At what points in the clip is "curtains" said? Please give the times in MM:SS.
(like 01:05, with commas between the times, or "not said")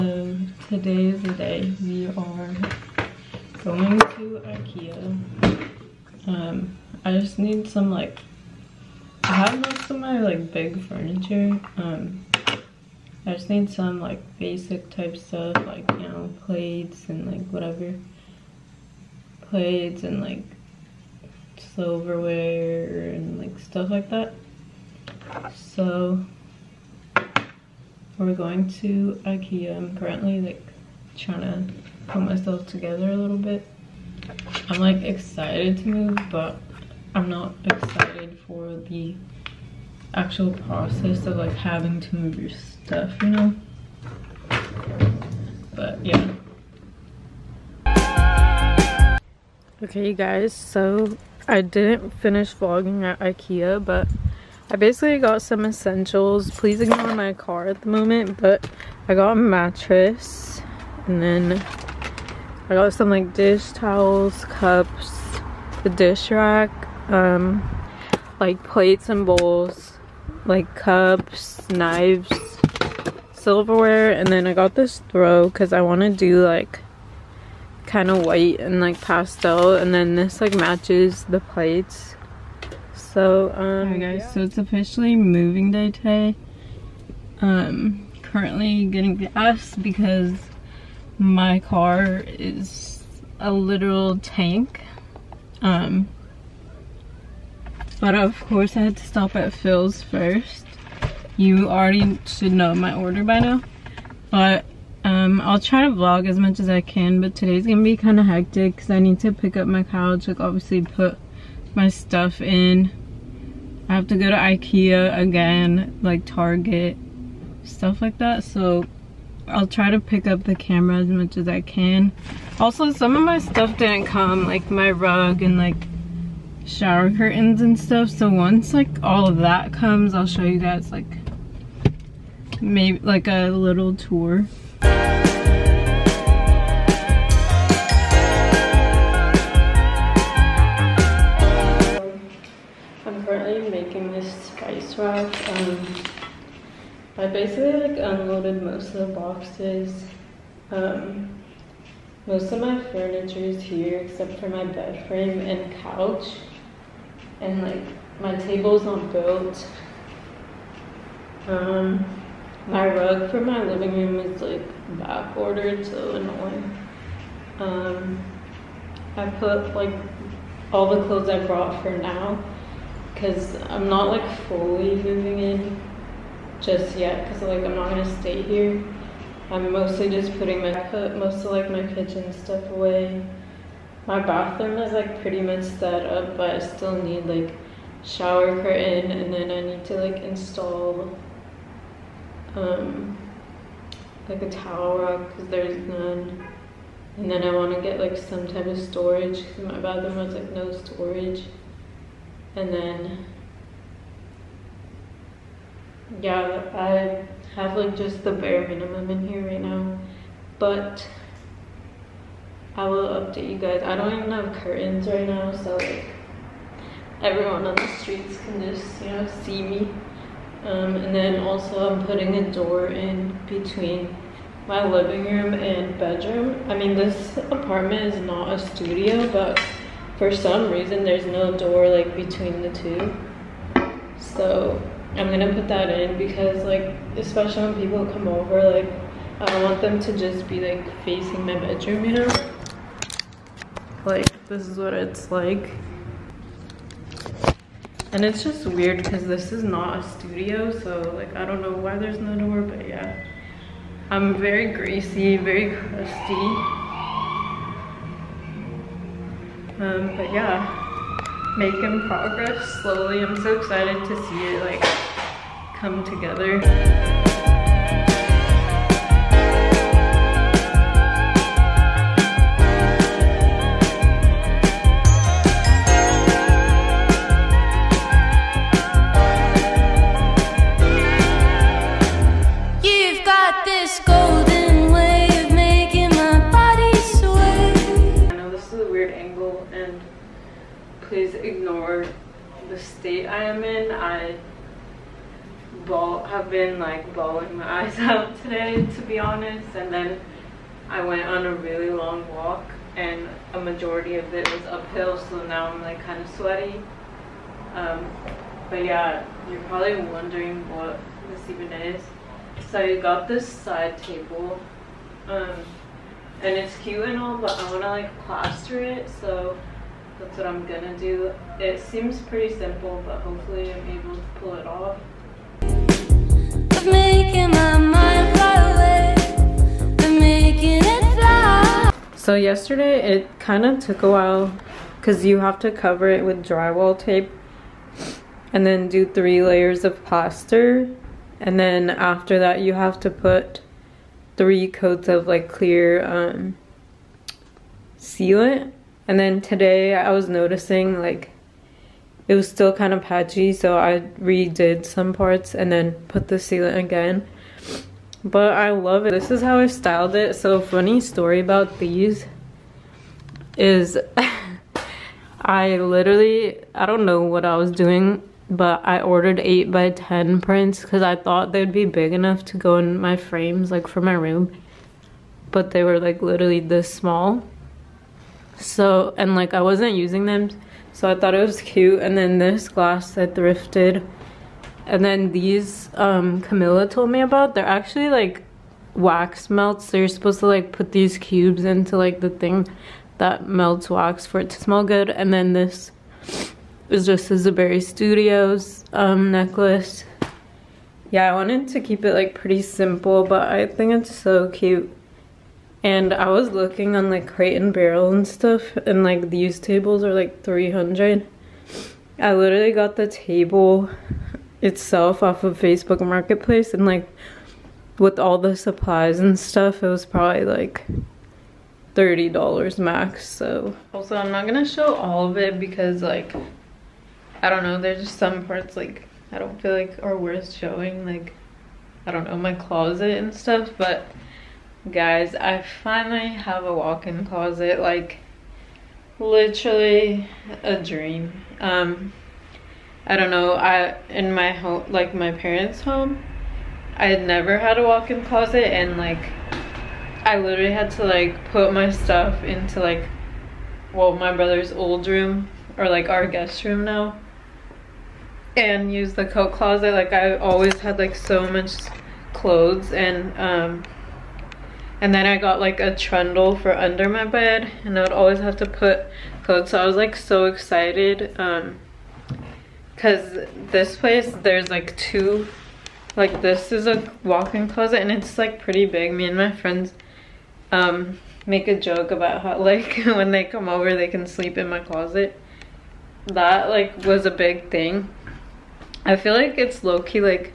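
02:07, 03:08, 03:34.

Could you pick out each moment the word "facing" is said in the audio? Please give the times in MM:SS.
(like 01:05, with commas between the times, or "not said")
04:01.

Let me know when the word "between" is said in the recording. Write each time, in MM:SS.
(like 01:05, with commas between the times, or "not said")
03:43, 03:52.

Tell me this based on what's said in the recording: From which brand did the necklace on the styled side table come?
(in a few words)
Zuberi Studios.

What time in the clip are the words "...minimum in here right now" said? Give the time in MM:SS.
03:28.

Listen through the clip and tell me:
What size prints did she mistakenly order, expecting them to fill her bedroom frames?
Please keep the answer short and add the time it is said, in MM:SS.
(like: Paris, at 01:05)
8 by 10, at 06:09.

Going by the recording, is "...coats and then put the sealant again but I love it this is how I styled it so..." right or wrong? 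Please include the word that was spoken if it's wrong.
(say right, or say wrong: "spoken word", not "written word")
wrong: "parts", not "coats".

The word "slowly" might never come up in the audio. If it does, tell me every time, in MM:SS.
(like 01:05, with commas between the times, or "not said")
04:22.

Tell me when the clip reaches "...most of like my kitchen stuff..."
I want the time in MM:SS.
03:01.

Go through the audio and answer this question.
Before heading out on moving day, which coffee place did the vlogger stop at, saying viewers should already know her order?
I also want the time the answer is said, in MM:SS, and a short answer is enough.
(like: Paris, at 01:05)
Phil's, at 01:39.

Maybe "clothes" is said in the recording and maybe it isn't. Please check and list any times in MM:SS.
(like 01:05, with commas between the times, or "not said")
02:51, 07:42, 07:49.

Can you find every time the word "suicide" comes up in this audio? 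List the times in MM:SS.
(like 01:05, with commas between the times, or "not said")
not said.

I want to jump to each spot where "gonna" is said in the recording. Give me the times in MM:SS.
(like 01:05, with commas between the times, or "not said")
01:47, 02:57, 03:55, 07:04.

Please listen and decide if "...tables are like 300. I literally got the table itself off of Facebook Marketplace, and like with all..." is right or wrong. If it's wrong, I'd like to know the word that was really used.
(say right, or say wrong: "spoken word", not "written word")
right.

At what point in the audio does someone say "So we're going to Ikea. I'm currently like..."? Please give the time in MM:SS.
00:25.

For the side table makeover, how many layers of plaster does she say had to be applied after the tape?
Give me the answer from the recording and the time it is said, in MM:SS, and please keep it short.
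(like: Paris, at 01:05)
3, at 05:39.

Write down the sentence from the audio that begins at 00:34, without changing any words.
I'm like excited to move, but I'm not excited for the actual process of like having to move your stuff, you know?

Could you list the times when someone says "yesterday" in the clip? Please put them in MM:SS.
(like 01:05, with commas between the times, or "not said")
05:32.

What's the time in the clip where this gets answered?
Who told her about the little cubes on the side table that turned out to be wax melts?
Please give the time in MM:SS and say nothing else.
06:26.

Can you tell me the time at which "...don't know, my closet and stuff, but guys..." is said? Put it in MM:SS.
07:12.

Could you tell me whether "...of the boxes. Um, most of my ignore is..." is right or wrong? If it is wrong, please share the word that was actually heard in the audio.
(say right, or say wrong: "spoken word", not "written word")
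wrong: "furniture", not "ignore".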